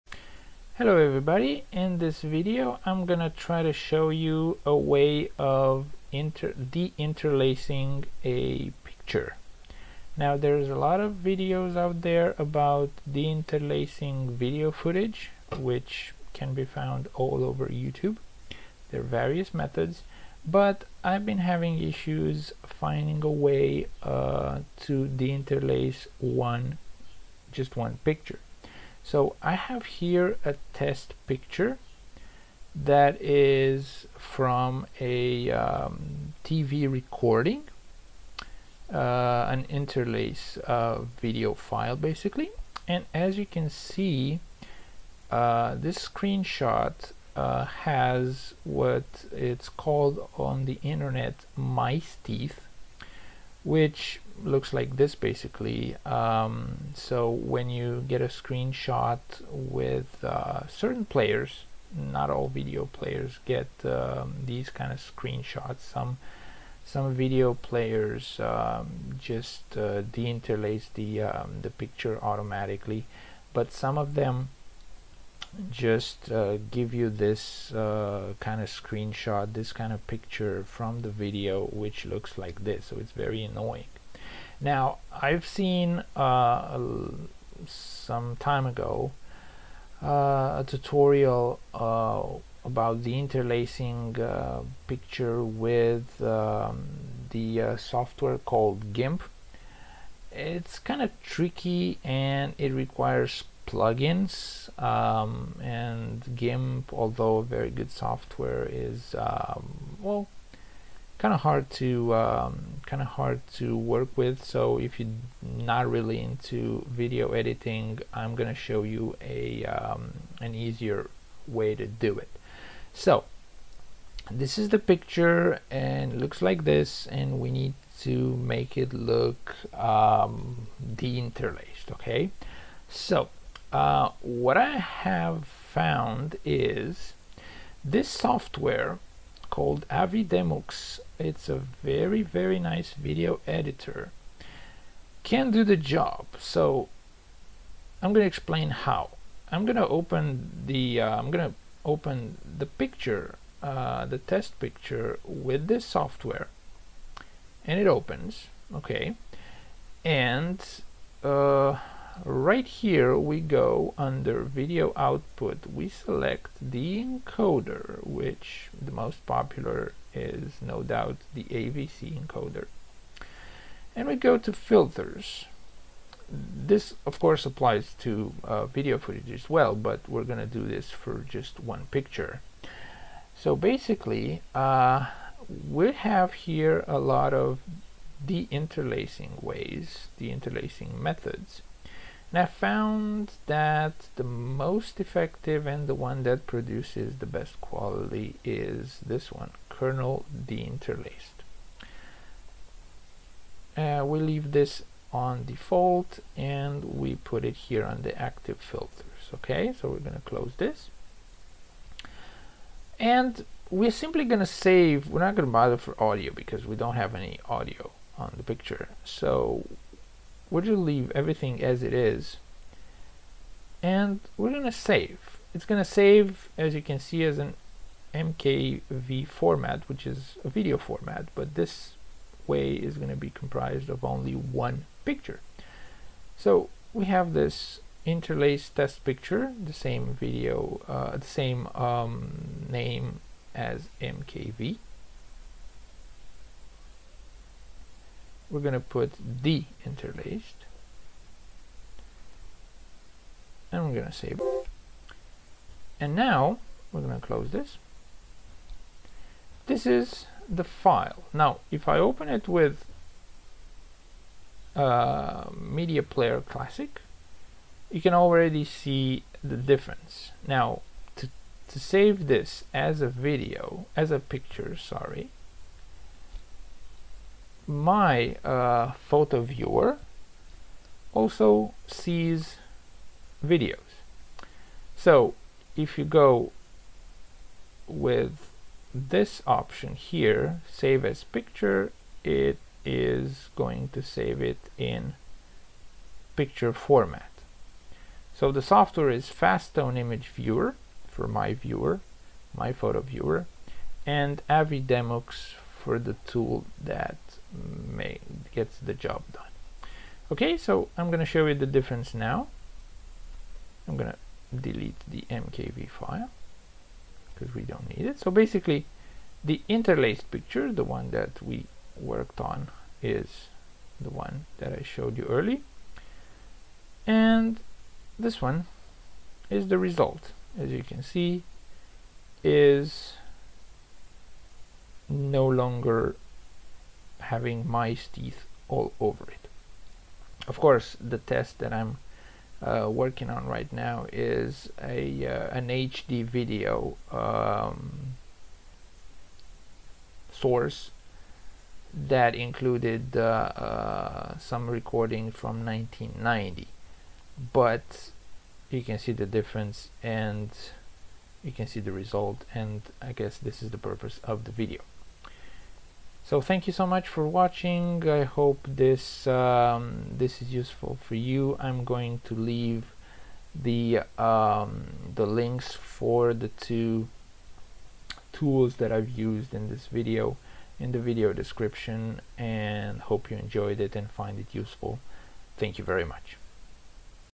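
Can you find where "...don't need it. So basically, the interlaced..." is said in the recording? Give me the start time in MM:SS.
05:17.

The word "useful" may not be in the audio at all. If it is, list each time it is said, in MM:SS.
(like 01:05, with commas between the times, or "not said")
06:10, 06:24.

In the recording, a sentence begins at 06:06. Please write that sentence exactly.
So thank you so much for watching.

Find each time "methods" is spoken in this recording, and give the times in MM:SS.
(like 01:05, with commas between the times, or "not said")
00:19, 03:10.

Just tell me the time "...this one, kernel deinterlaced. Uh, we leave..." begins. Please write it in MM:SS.
03:19.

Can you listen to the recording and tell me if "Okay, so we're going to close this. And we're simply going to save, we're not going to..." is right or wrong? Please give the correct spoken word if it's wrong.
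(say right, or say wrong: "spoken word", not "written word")
right.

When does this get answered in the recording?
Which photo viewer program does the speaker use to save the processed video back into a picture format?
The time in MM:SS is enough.
04:59.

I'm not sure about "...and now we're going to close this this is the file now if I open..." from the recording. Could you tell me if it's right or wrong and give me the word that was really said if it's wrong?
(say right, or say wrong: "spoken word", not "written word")
right.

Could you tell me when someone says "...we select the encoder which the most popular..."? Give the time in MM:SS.
02:45.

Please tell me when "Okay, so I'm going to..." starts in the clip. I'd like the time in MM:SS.
05:10.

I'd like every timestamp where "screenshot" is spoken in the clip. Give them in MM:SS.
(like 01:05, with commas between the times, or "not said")
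00:46, 00:58, 01:04, 01:18.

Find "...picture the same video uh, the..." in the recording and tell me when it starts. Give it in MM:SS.
03:59.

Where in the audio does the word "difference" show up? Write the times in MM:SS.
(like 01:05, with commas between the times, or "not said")
04:29, 05:11, 05:59.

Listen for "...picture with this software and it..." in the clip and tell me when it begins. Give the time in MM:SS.
02:34.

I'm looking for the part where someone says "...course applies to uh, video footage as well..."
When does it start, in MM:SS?
02:57.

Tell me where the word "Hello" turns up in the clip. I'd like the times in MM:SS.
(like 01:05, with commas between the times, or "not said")
00:00.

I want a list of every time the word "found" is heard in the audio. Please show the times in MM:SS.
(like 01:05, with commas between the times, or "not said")
00:16, 02:15, 03:12.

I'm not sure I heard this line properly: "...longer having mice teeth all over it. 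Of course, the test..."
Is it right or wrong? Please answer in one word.
right.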